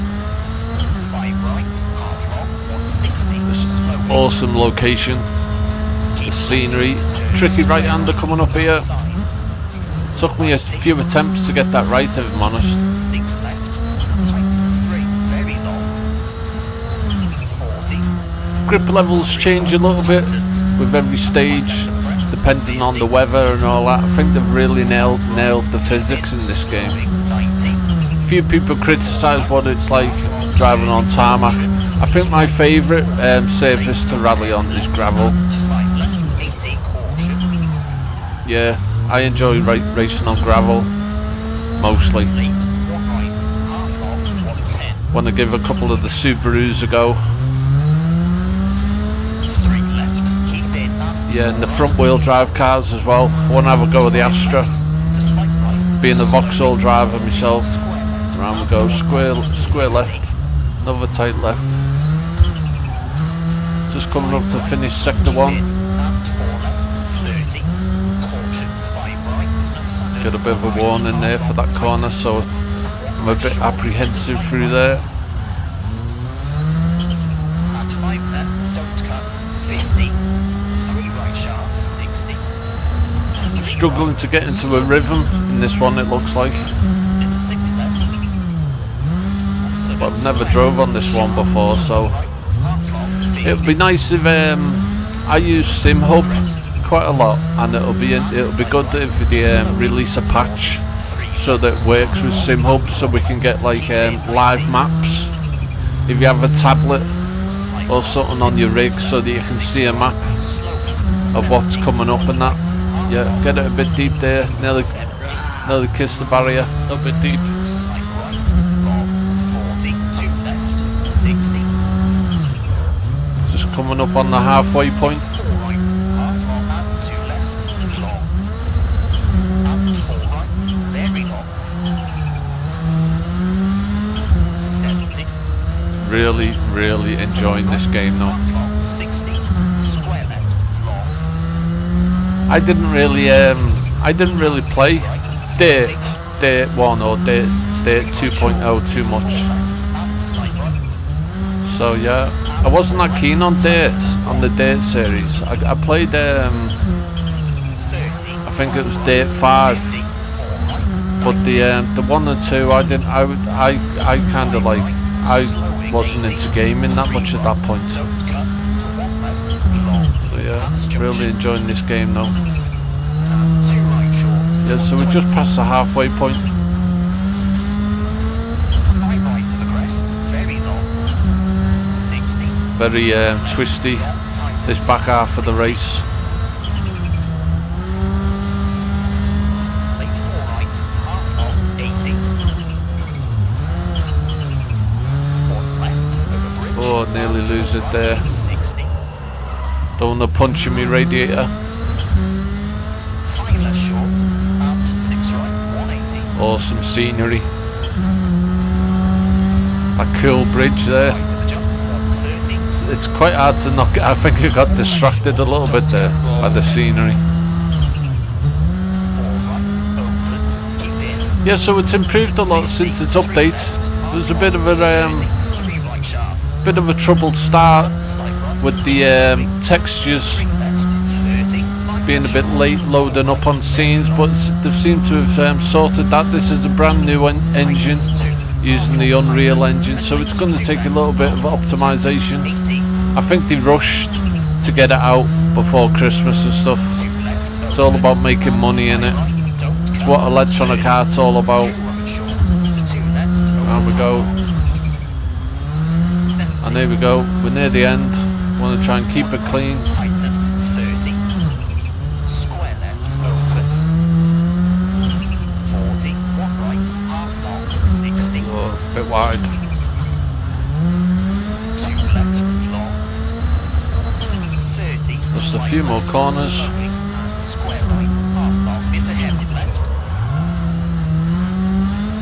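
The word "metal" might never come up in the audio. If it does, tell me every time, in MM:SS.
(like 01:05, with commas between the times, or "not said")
not said.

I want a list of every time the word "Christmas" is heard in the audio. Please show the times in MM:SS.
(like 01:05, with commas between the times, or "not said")
04:05.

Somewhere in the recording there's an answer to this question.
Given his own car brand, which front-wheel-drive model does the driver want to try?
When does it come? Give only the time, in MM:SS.
00:54.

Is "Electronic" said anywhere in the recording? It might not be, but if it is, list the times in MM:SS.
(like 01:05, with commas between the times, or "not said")
04:10.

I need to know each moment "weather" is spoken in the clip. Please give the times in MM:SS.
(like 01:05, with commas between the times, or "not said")
00:23.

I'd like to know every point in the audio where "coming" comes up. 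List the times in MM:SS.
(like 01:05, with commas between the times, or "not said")
00:08, 01:04, 01:51, 02:03.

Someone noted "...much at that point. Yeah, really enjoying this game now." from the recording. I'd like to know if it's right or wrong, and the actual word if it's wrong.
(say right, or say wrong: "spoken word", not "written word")
right.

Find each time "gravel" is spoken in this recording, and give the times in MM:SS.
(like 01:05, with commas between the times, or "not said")
00:34, 00:40.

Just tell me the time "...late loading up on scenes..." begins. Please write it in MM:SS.
03:52.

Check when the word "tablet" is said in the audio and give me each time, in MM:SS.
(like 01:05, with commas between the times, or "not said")
01:46.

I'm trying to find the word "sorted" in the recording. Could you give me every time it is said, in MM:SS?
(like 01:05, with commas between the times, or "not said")
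03:55.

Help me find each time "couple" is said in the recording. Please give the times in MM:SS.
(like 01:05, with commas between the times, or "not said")
00:45.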